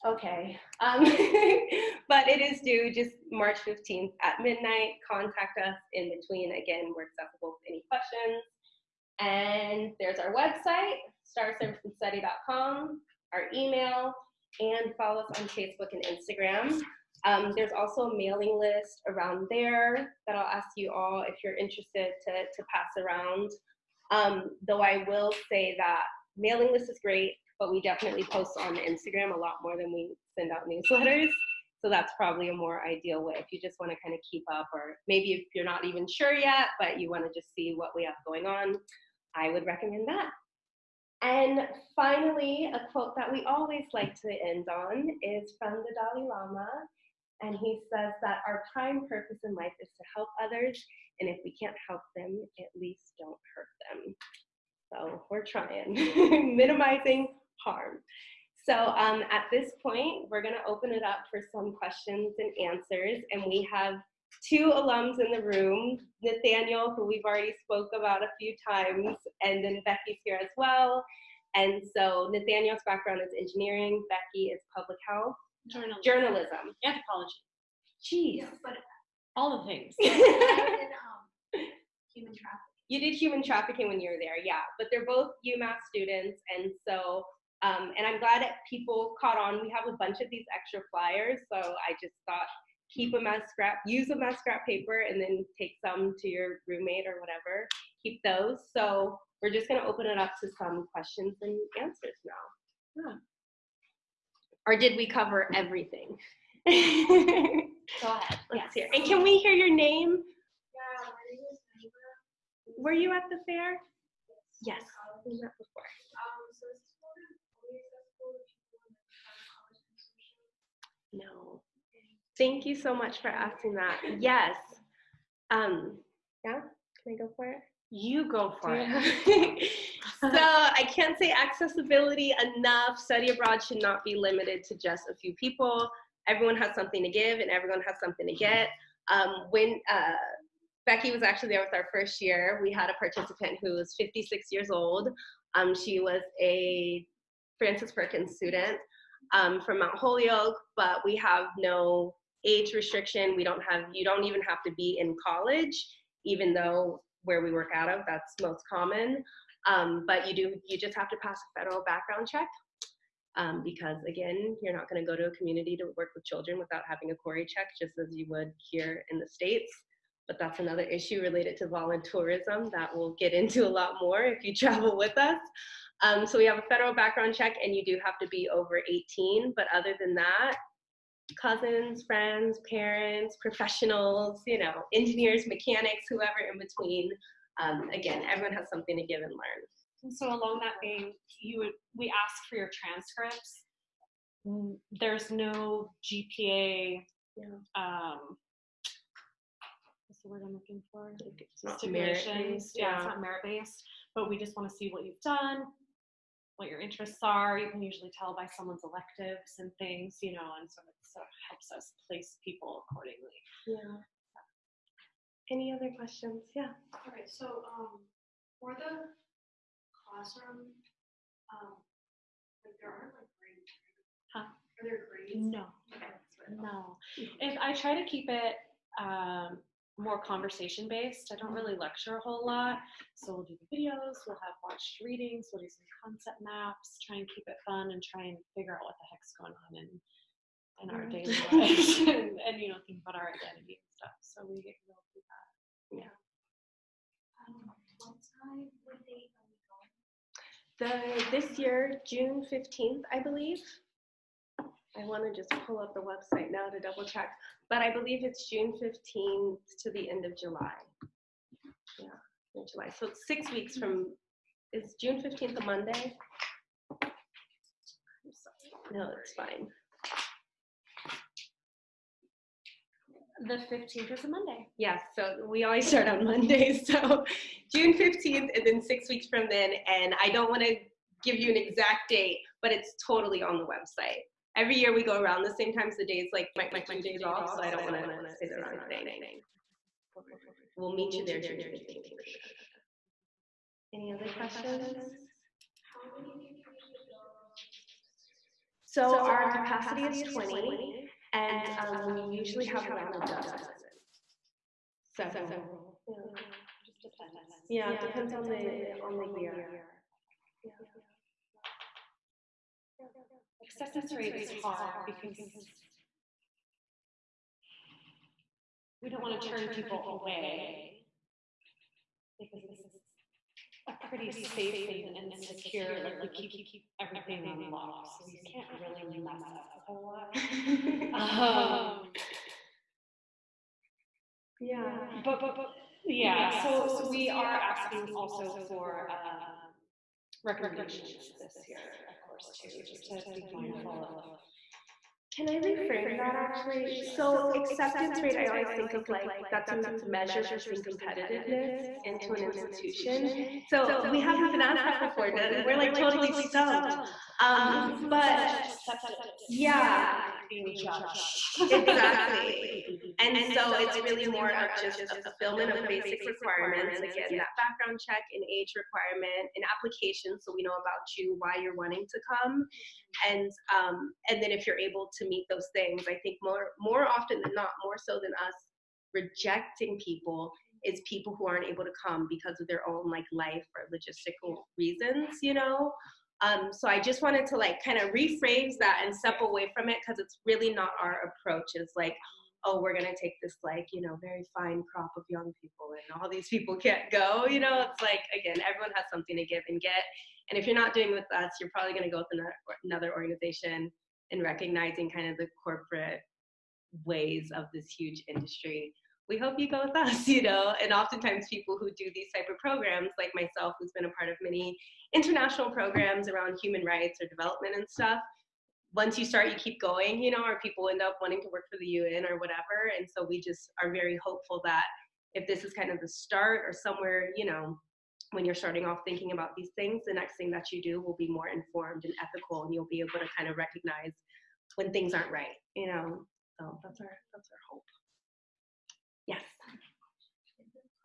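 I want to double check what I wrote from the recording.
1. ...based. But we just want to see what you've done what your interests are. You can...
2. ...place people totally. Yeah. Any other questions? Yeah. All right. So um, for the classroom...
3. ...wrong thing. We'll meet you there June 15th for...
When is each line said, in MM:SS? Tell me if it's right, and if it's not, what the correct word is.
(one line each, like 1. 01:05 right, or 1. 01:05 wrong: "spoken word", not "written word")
1. 03:23 right
2. 03:32 wrong: "accordingly", not "totally"
3. 04:48 right.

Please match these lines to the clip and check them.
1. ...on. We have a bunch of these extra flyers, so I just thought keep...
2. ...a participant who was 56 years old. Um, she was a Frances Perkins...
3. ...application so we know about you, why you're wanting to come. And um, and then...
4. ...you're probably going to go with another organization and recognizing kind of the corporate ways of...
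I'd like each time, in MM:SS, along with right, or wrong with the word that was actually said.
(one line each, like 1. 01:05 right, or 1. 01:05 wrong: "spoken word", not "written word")
1. 01:29 right
2. 02:22 right
3. 06:09 right
4. 06:41 right.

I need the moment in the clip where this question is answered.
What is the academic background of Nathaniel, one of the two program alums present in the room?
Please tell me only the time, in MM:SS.
01:13.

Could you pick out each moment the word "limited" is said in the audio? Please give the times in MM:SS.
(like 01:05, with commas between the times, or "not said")
02:14.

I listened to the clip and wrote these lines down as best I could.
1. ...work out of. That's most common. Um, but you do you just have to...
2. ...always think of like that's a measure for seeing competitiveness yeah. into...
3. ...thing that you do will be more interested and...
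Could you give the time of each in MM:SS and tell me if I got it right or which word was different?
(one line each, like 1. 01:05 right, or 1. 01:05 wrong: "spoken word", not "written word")
1. 02:37 right
2. 05:48 right
3. 07:10 wrong: "informed", not "interested".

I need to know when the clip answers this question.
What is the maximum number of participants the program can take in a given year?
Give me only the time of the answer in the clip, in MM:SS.
05:00.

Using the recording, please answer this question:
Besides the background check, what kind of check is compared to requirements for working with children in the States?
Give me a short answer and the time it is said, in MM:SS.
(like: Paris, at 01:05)
CORI check, at 02:47.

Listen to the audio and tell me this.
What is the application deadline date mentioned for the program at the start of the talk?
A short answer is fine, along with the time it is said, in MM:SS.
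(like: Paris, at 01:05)
March 15, at 00:03.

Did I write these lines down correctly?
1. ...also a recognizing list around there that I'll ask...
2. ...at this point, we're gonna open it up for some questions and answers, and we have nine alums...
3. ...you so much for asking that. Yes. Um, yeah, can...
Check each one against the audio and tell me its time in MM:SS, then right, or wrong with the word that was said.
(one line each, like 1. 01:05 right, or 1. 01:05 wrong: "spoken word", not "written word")
1. 00:17 wrong: "mailing", not "recognizing"
2. 00:59 wrong: "two", not "nine"
3. 02:02 right.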